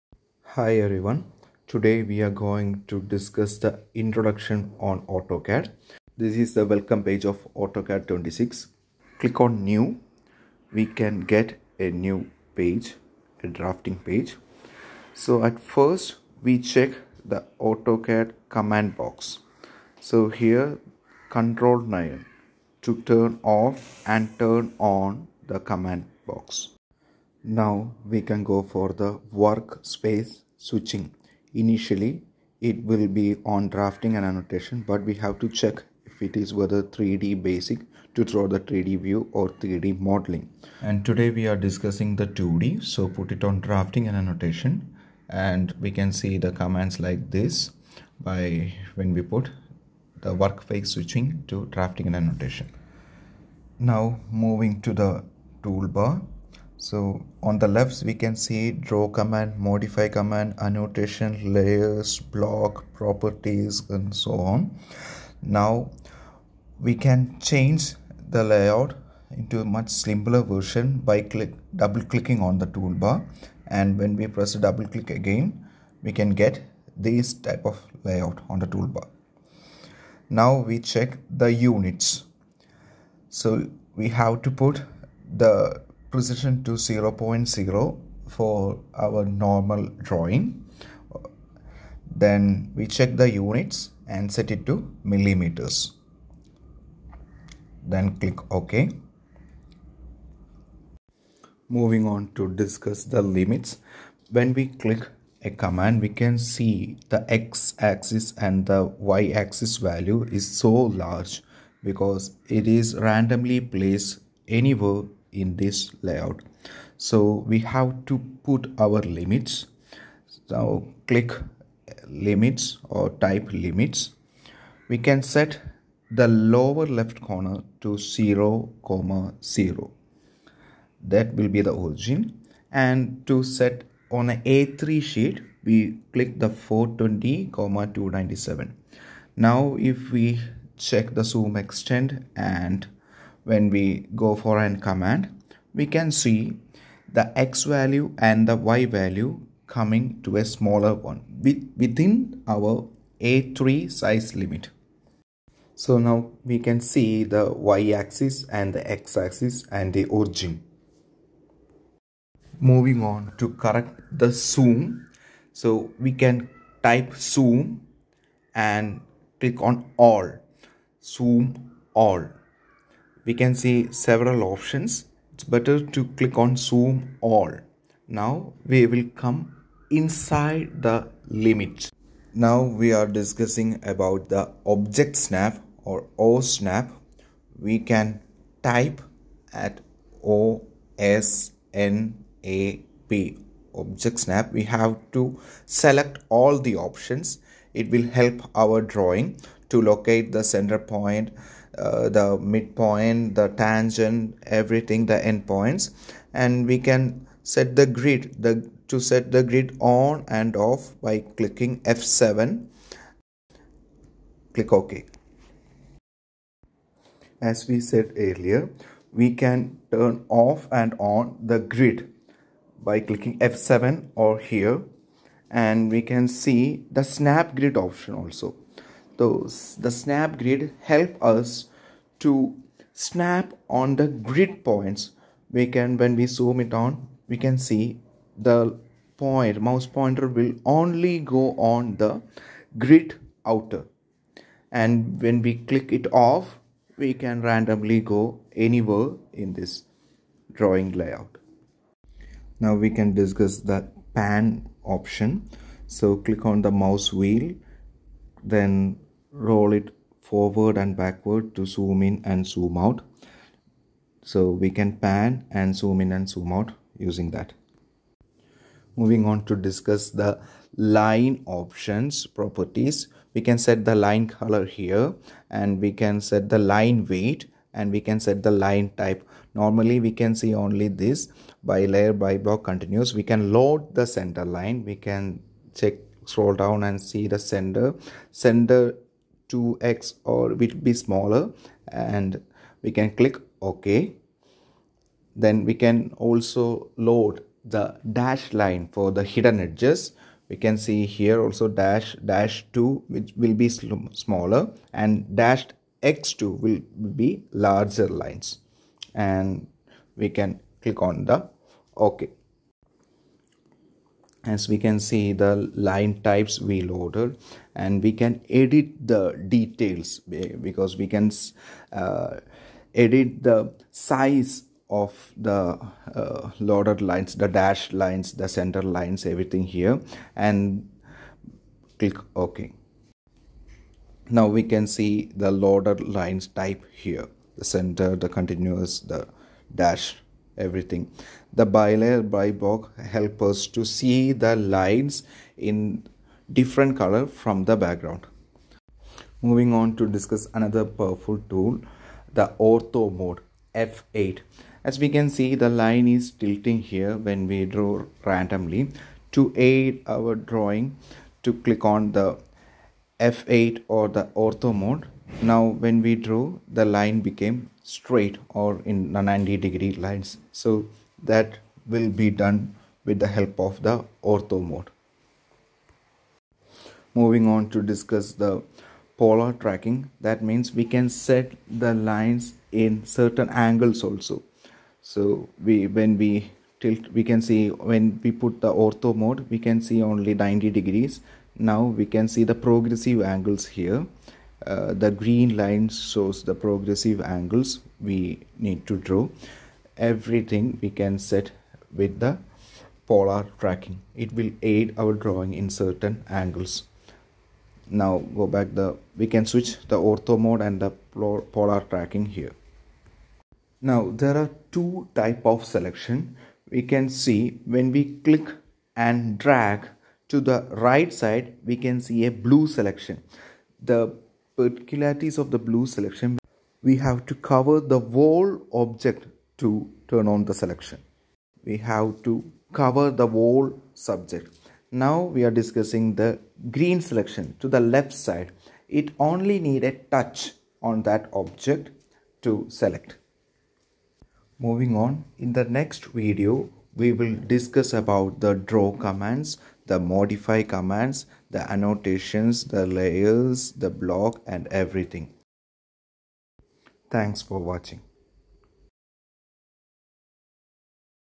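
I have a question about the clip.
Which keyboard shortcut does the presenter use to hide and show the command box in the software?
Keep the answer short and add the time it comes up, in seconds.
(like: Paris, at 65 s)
Control 9, at 21 s.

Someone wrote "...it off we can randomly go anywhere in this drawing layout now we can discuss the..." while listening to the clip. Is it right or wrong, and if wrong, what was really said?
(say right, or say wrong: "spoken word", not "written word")
right.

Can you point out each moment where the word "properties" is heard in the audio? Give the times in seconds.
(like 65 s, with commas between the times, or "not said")
62 s, 272 s.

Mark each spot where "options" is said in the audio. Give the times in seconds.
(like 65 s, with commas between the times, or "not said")
174 s, 196 s, 227 s, 254 s, 271 s.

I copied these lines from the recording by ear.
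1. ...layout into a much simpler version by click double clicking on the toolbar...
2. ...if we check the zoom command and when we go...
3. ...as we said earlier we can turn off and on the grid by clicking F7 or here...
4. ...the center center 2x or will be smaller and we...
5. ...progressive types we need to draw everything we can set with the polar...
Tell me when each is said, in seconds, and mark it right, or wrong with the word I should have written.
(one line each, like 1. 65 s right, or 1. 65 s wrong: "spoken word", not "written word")
1. 68 s right
2. 139 s wrong: "extend", not "command"
3. 217 s right
4. 287 s right
5. 396 s wrong: "angles", not "types".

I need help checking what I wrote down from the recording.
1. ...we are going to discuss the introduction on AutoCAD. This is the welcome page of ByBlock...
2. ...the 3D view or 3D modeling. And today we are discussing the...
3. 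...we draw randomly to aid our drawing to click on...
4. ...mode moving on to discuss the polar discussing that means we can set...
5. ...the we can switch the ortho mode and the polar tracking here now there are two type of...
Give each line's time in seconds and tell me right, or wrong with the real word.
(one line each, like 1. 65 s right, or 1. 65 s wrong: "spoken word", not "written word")
1. 2 s wrong: "AutoCAD", not "ByBlock"
2. 38 s right
3. 357 s right
4. 374 s wrong: "tracking", not "discussing"
5. 408 s right.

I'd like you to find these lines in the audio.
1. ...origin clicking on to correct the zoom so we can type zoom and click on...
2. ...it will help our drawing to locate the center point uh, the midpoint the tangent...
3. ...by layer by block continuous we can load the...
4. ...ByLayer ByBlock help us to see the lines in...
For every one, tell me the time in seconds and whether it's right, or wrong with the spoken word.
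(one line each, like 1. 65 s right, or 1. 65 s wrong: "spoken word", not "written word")
1. 160 s wrong: "moving", not "clicking"
2. 197 s right
3. 281 s right
4. 341 s right.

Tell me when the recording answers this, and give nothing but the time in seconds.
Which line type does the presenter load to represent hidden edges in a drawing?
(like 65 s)
298 s.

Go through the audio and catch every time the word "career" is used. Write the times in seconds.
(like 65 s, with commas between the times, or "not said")
not said.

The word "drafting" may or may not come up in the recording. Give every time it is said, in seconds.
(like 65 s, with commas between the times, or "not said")
13 s, 33 s, 43 s, 51 s.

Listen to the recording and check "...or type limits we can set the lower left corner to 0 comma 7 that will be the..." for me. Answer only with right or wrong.
wrong.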